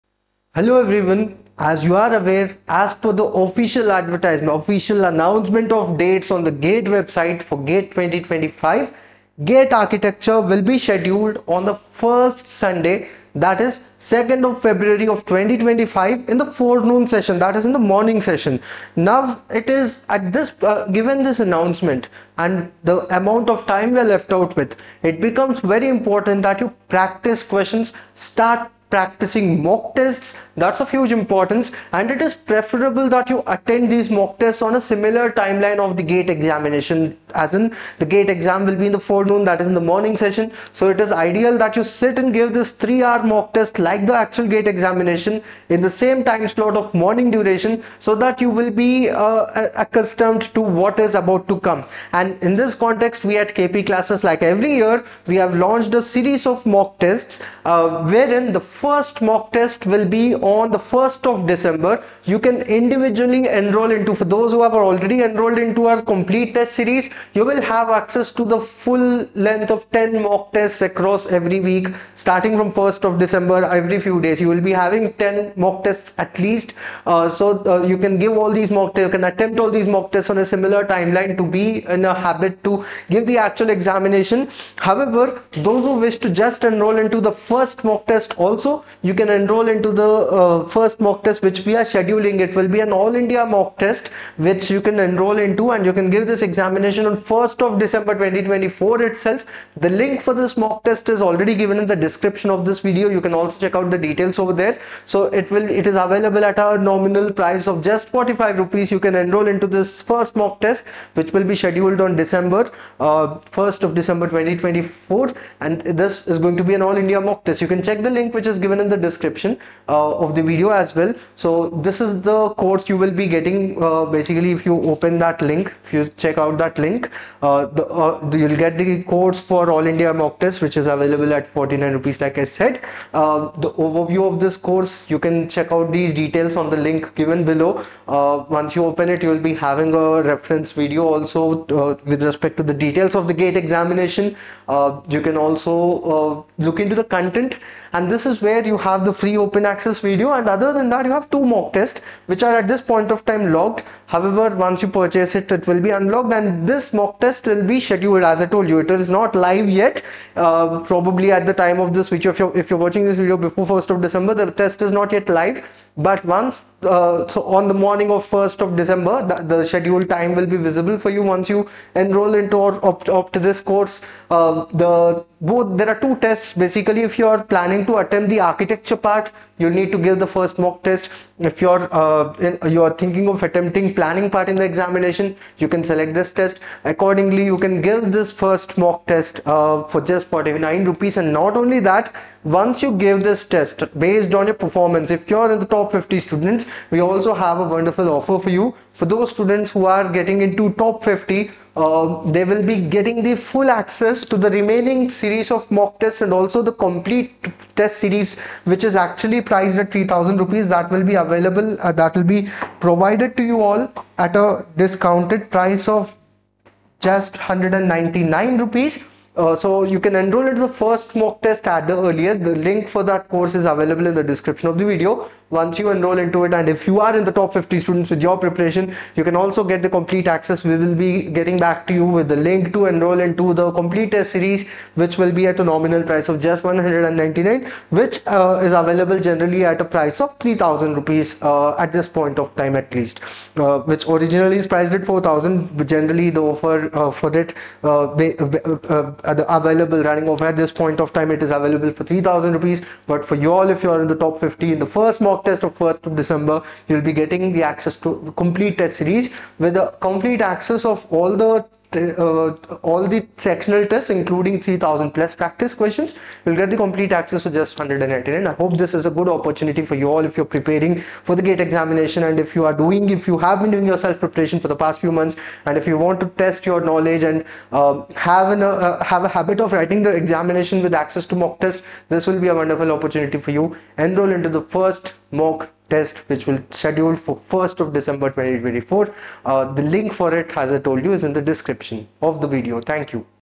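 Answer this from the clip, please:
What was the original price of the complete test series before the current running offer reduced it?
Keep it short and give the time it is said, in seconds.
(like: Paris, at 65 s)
4000 rupees, at 245 s.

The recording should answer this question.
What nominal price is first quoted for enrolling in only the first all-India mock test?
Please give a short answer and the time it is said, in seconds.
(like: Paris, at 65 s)
45 rupees, at 108 s.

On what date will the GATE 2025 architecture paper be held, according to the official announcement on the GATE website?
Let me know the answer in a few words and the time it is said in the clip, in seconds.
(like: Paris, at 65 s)
2 February 2025, at 14 s.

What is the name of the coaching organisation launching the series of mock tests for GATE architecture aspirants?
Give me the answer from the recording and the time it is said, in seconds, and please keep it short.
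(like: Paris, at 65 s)
KP Classes, at 53 s.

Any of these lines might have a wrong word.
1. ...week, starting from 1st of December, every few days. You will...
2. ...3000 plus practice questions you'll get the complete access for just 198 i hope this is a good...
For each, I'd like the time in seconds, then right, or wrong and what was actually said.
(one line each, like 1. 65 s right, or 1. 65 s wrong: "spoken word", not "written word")
1. 71 s right
2. 264 s wrong: "199", not "198".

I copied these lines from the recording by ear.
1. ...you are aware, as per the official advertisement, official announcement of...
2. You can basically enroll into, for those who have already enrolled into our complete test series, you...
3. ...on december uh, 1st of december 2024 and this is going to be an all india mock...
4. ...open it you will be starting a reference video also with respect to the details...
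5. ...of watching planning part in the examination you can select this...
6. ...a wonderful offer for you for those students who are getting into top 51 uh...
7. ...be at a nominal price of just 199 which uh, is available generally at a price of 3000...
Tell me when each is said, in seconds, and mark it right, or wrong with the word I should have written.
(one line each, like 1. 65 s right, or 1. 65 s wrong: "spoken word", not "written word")
1. 1 s right
2. 62 s wrong: "individually", not "basically"
3. 112 s right
4. 138 s wrong: "having", not "starting"
5. 183 s wrong: "attempting", not "watching"
6. 197 s wrong: "50", not "51"
7. 235 s right.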